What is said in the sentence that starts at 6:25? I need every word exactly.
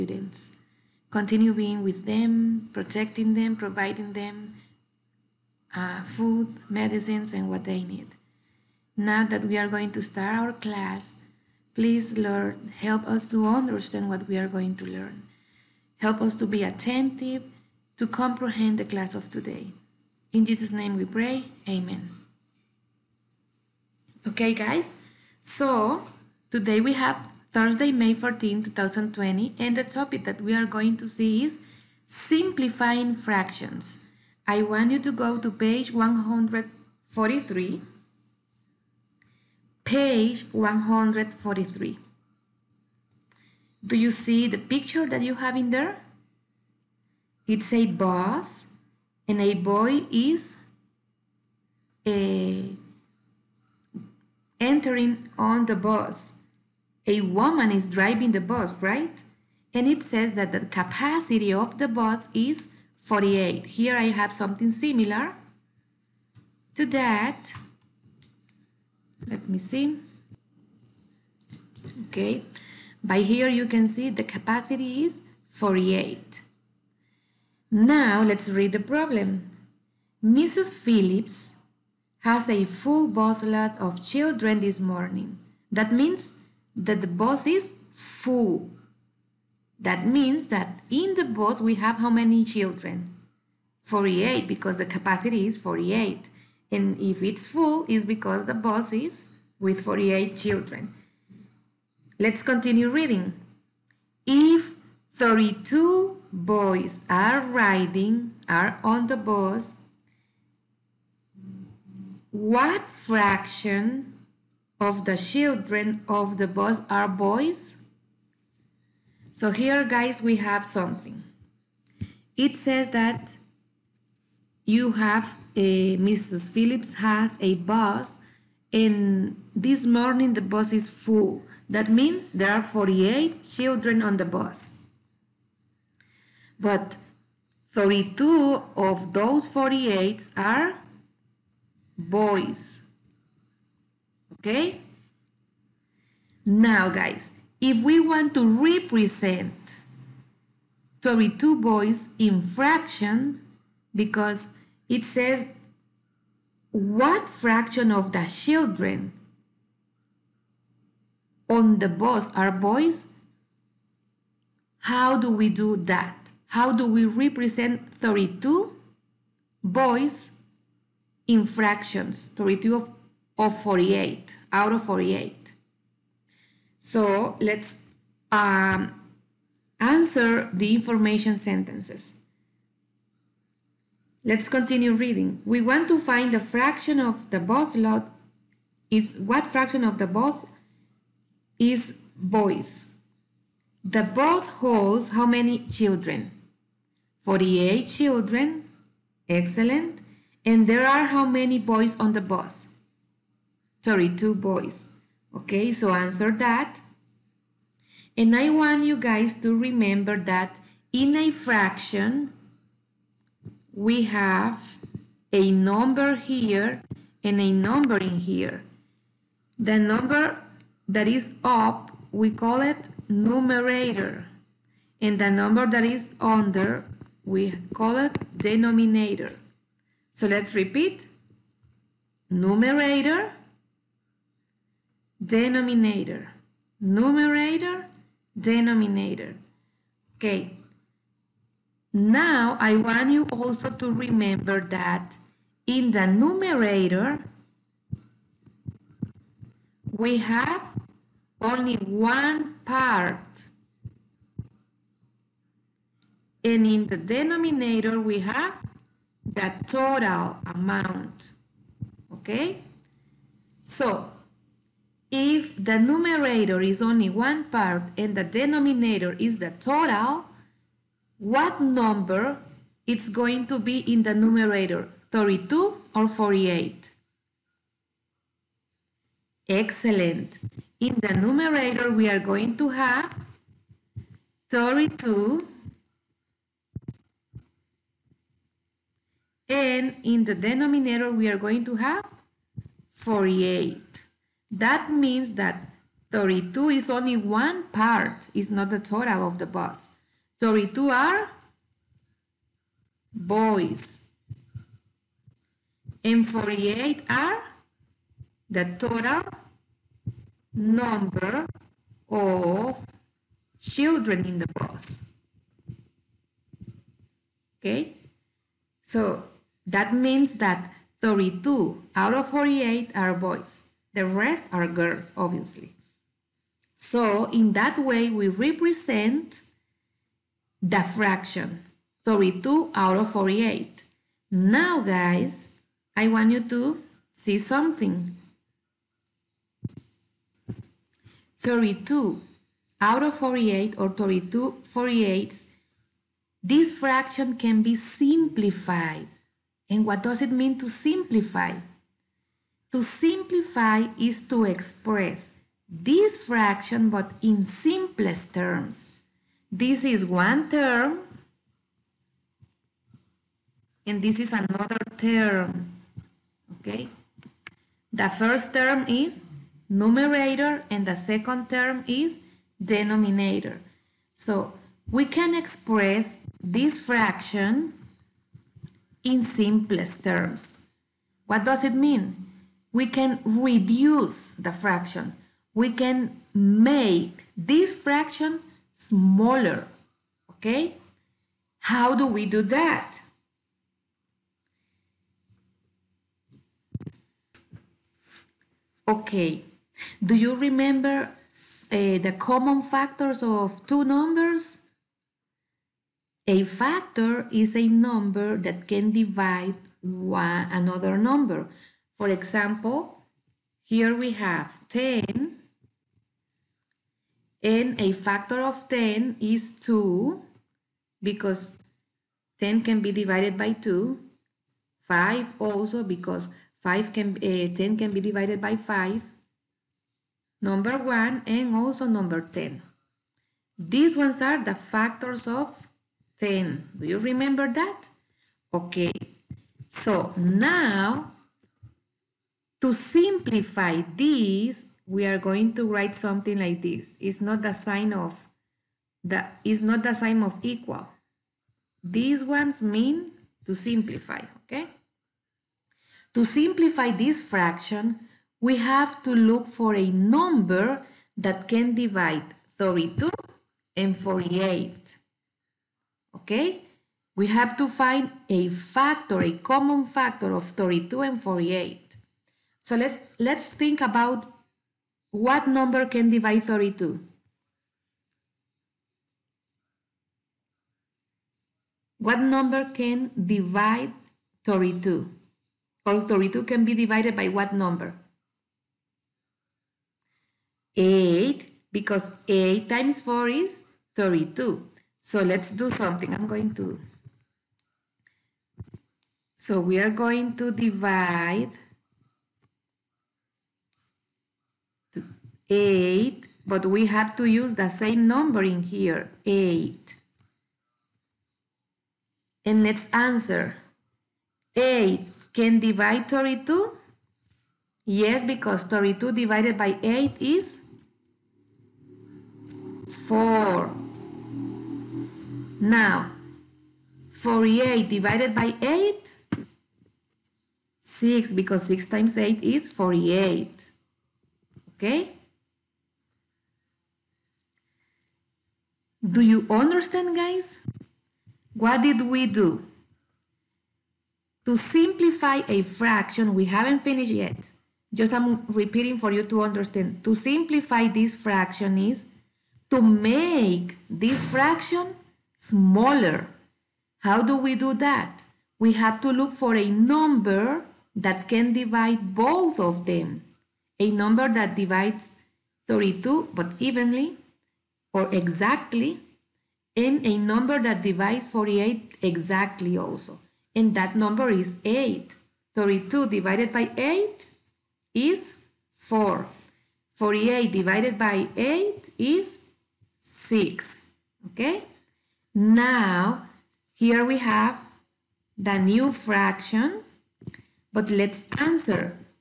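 We can make this fraction smaller, okay?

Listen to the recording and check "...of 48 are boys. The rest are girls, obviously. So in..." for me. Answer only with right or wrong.
right.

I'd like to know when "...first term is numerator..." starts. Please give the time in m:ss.
6:08.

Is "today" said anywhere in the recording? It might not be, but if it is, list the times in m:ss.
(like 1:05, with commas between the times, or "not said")
0:19, 0:26.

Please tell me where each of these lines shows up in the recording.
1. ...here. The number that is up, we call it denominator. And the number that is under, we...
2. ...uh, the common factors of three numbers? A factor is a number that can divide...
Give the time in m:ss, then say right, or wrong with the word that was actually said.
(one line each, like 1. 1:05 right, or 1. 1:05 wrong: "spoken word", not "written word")
1. 3:38 wrong: "numerator", not "denominator"
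2. 6:41 wrong: "two", not "three".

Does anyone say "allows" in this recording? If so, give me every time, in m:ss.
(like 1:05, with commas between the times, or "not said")
not said.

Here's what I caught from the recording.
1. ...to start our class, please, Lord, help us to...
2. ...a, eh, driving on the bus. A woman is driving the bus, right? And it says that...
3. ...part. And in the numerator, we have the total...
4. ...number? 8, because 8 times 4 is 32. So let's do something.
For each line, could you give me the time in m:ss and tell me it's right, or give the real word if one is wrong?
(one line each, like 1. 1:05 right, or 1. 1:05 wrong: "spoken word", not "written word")
1. 0:09 right
2. 0:52 wrong: "entering", not "driving"
3. 4:12 wrong: "denominator", not "numerator"
4. 8:07 right.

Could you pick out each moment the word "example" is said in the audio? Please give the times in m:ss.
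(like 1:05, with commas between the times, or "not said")
6:52.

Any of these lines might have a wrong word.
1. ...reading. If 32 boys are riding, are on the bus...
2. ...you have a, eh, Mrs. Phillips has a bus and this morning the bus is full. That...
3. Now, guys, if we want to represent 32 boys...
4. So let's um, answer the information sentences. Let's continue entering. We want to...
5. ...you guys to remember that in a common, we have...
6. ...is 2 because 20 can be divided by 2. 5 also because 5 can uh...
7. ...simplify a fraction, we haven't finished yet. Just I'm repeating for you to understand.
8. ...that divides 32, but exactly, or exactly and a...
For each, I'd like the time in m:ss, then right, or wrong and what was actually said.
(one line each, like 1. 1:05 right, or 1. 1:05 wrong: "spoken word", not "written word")
1. 1:42 right
2. 2:04 right
3. 2:26 right
4. 2:56 wrong: "reading", not "entering"
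5. 3:28 wrong: "fraction", not "common"
6. 6:59 wrong: "10", not "20"
7. 9:04 right
8. 9:24 wrong: "evenly", not "exactly".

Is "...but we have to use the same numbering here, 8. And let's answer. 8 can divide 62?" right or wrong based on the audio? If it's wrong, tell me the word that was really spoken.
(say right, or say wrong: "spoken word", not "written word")
wrong: "32", not "62".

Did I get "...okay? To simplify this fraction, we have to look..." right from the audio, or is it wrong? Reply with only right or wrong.
right.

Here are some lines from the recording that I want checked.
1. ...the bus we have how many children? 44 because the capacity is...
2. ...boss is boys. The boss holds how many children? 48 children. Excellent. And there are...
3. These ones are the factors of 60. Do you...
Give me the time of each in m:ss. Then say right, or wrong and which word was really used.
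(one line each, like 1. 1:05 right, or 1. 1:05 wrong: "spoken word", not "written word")
1. 1:31 wrong: "48", not "44"
2. 3:10 right
3. 7:13 wrong: "10", not "60".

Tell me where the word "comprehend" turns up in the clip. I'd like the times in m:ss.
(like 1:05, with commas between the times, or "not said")
0:18.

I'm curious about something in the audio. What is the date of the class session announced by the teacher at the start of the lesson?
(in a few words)
Thursday, May 14, 2020.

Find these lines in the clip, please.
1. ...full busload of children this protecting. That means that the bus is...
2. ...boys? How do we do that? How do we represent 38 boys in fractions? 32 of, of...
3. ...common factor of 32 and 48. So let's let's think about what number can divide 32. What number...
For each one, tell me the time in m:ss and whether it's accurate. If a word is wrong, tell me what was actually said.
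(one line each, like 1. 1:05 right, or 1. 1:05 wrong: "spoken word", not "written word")
1. 1:22 wrong: "morning", not "protecting"
2. 2:42 wrong: "32", not "38"
3. 7:49 right.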